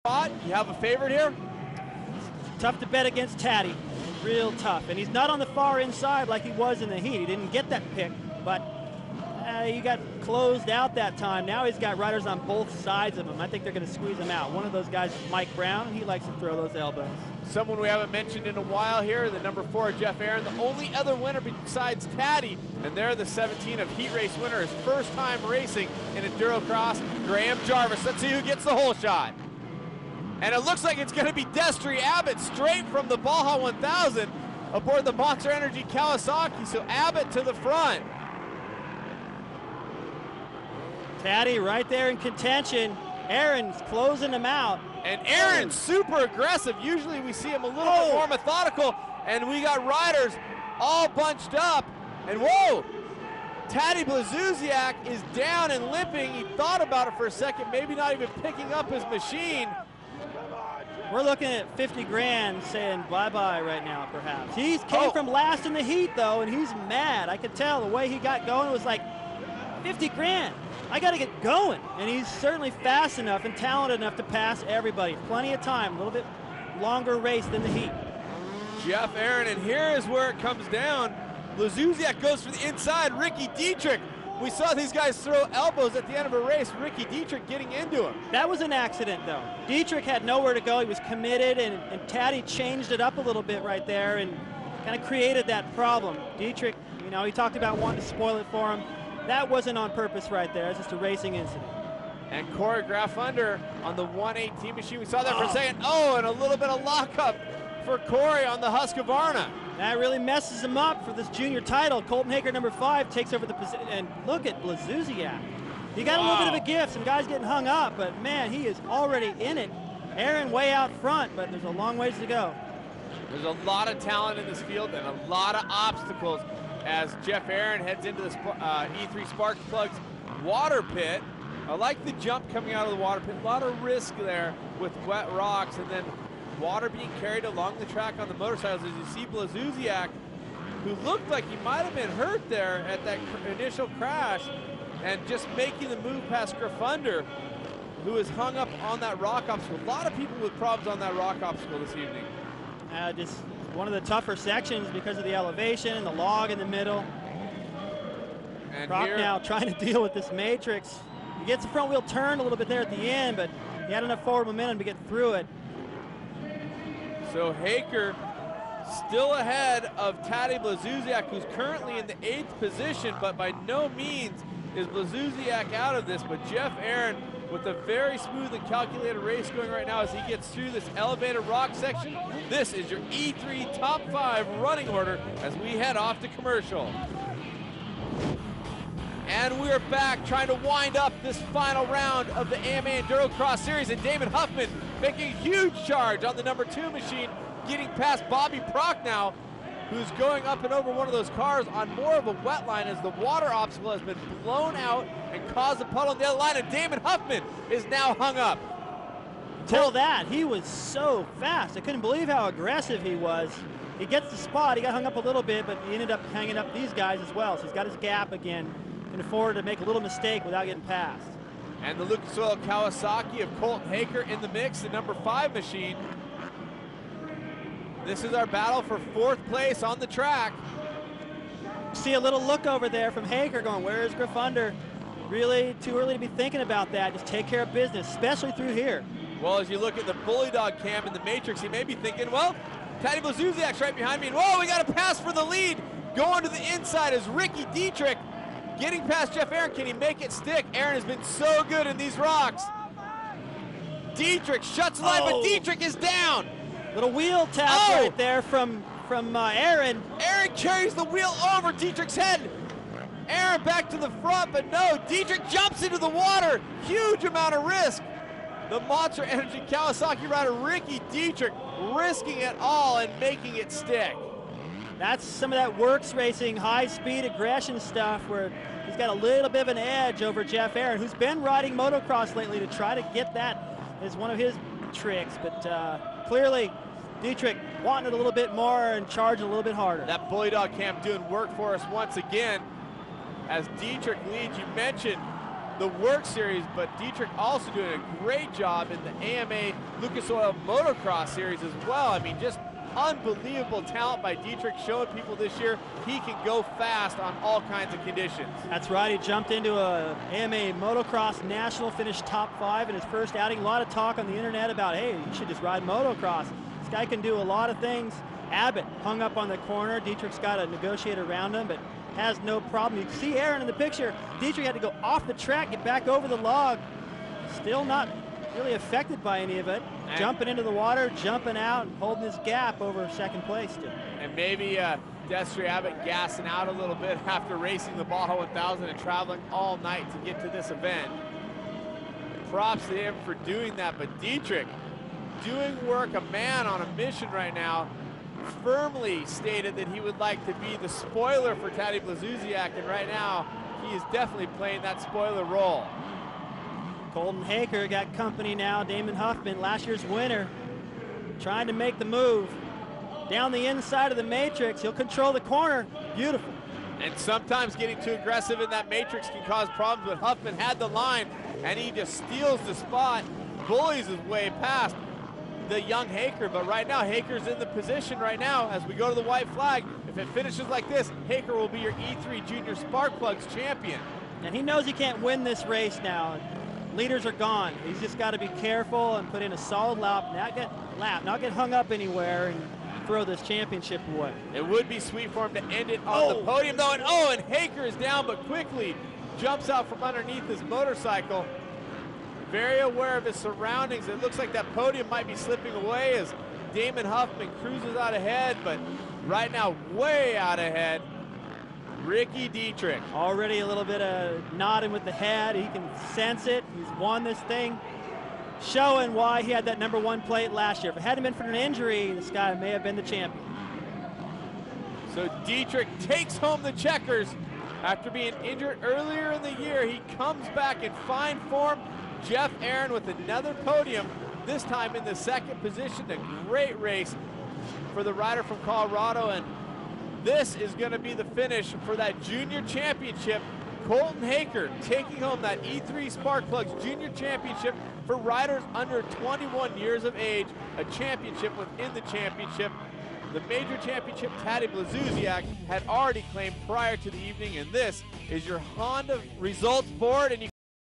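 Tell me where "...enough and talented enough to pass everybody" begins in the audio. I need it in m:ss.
1:13.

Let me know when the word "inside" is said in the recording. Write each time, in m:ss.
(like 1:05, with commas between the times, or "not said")
0:05, 1:22, 4:06, 6:03.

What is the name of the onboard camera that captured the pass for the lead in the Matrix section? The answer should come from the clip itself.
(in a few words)
Bully Dog cam.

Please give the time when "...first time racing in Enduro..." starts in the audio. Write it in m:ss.
0:24.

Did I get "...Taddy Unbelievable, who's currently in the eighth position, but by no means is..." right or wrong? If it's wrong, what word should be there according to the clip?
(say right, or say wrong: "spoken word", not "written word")
wrong: "Blazusiak", not "Unbelievable".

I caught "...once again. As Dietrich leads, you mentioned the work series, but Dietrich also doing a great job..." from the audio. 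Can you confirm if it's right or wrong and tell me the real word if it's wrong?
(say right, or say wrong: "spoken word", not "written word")
right.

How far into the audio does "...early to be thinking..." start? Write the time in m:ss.
3:55.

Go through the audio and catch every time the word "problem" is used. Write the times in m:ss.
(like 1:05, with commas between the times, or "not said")
1:35, 2:30, 5:22, 6:09.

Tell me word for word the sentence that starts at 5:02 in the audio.
I mean, just Unbelievable talent by Dietrich showing people this year he can go fast on all kinds of conditions.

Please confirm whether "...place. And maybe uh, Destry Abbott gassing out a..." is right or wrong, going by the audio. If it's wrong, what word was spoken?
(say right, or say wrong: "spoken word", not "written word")
right.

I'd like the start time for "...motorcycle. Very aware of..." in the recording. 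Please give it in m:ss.
6:40.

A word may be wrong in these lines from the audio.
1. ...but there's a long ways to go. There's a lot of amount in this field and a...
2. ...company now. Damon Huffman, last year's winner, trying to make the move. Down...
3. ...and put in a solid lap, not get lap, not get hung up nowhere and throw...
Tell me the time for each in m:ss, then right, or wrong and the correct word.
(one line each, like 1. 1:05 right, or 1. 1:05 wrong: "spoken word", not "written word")
1. 2:01 wrong: "talent", not "amount"
2. 5:58 right
3. 6:29 wrong: "anywhere", not "nowhere".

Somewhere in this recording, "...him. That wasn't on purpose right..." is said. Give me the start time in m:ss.
1:38.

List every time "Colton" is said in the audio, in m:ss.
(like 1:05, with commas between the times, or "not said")
1:52, 3:43, 5:57, 7:23.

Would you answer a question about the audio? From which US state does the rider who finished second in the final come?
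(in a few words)
Colorado.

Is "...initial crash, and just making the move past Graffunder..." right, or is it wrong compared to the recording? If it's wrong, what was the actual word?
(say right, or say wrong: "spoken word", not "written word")
right.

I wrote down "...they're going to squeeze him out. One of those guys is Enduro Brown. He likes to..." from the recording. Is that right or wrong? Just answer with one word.
wrong.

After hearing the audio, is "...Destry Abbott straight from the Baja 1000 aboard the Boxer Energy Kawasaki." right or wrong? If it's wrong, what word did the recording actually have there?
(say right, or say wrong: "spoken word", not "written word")
right.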